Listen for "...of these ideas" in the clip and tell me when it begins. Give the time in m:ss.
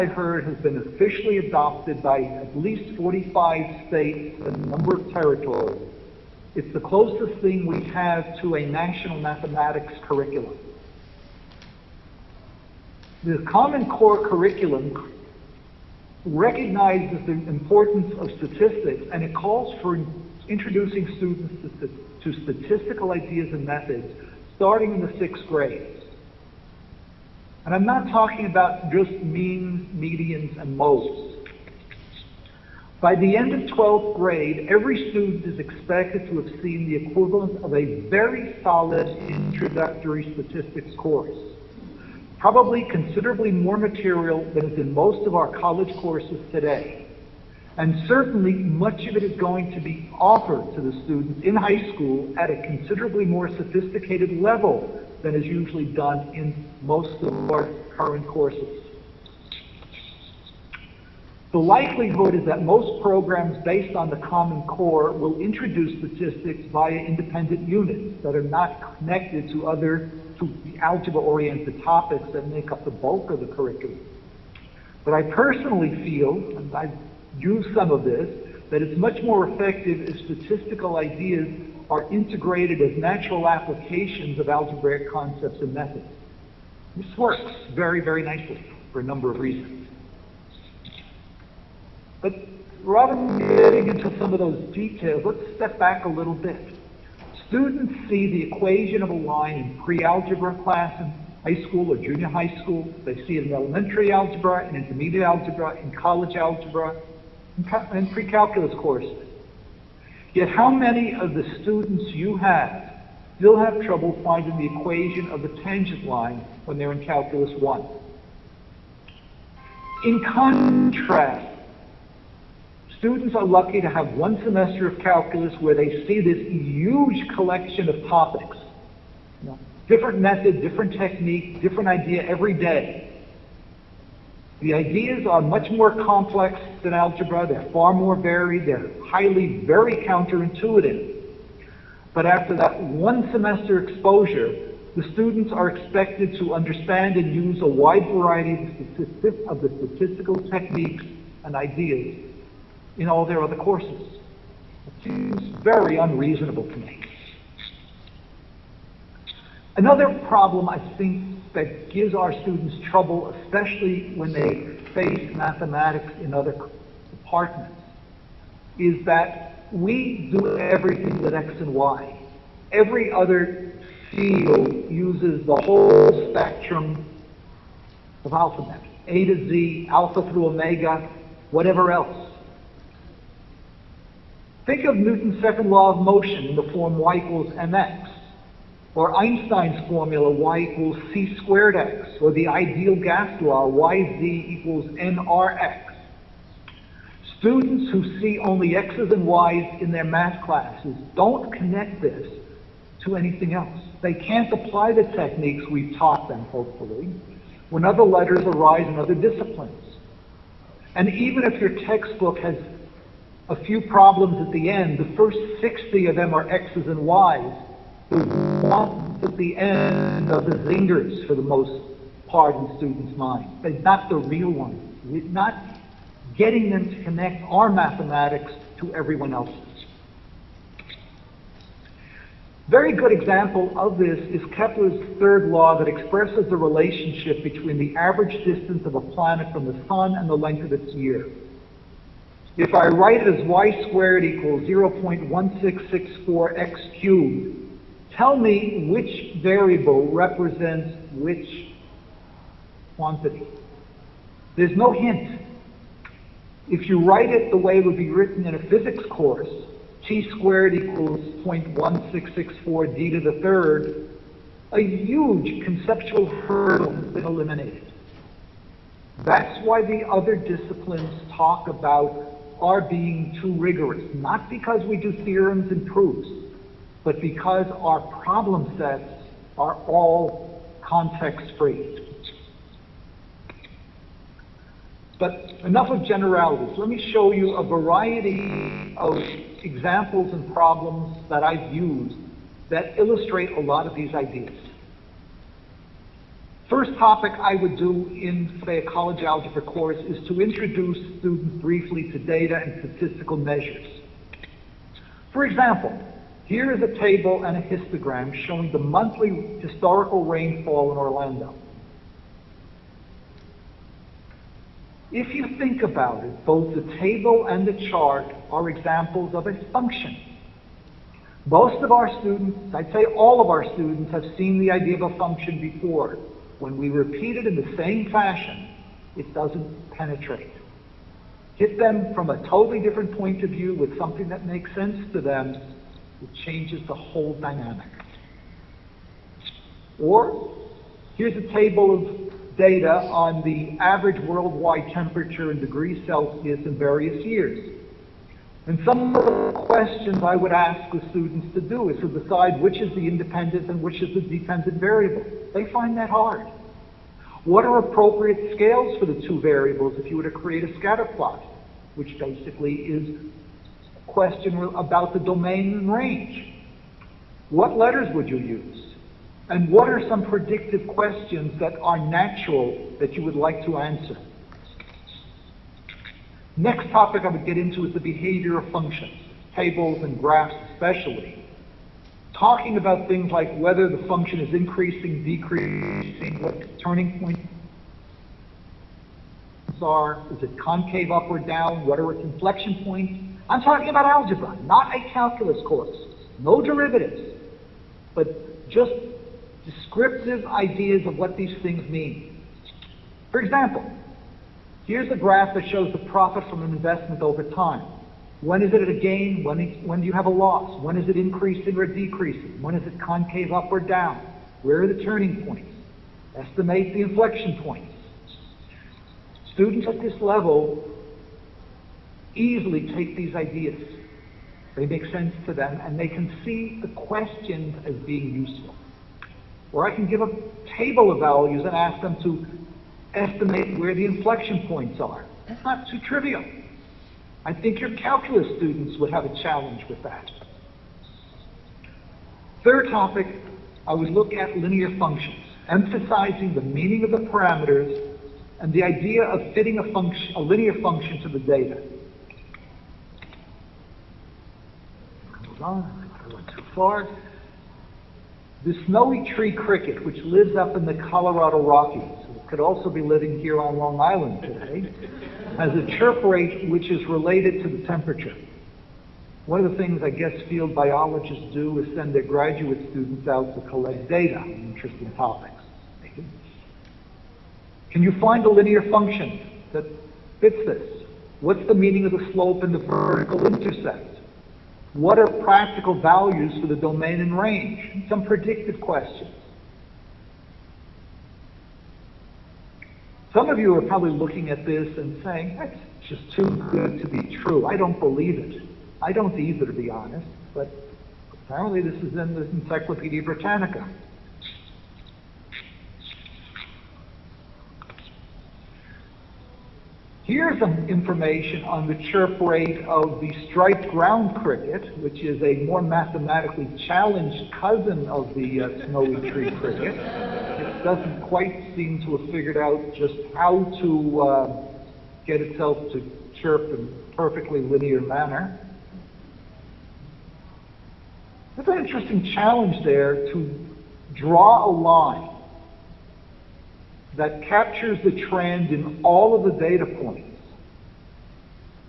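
4:53.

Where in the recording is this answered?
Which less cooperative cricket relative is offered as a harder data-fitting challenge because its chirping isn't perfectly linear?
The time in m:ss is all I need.
8:33.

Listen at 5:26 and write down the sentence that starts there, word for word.
When we repeat it in the same fashion, it doesn't penetrate.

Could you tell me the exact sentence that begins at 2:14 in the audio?
The ideas are much more complex than algebra.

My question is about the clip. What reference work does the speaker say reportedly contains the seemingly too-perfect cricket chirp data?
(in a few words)
Encyclopedia Britannica.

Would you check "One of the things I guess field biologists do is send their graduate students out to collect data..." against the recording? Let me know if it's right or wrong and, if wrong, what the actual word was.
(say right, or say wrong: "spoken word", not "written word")
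right.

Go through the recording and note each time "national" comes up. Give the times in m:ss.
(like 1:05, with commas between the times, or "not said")
0:08.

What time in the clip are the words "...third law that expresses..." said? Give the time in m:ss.
3:55.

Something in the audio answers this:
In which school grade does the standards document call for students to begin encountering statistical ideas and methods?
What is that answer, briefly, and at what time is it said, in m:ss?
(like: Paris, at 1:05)
sixth grade, at 0:25.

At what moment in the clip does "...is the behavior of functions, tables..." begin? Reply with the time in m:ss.
6:17.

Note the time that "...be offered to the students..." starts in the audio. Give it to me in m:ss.
0:49.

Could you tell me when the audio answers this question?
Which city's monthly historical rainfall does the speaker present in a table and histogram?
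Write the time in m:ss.
5:10.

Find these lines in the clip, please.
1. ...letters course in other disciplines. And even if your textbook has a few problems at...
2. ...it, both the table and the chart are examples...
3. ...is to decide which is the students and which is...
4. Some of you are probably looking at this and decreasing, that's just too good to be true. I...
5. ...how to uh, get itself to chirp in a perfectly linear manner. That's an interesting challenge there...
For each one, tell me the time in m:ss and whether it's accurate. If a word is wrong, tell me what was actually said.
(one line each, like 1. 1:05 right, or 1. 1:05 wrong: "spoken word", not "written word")
1. 3:28 wrong: "arise", not "course"
2. 5:16 right
3. 5:51 wrong: "independent", not "students"
4. 8:13 wrong: "saying", not "decreasing"
5. 8:43 right.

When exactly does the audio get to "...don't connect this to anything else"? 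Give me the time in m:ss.
3:21.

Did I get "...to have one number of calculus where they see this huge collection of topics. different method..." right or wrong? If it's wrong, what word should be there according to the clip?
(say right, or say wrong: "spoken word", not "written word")
wrong: "semester", not "number".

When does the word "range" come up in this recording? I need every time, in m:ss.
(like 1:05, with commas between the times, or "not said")
6:05, 8:07.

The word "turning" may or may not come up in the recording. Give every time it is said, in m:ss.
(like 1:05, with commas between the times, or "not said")
6:26, 6:55.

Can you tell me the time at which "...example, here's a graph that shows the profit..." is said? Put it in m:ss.
6:43.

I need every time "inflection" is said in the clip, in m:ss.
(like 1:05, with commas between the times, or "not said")
6:32, 6:57, 7:14.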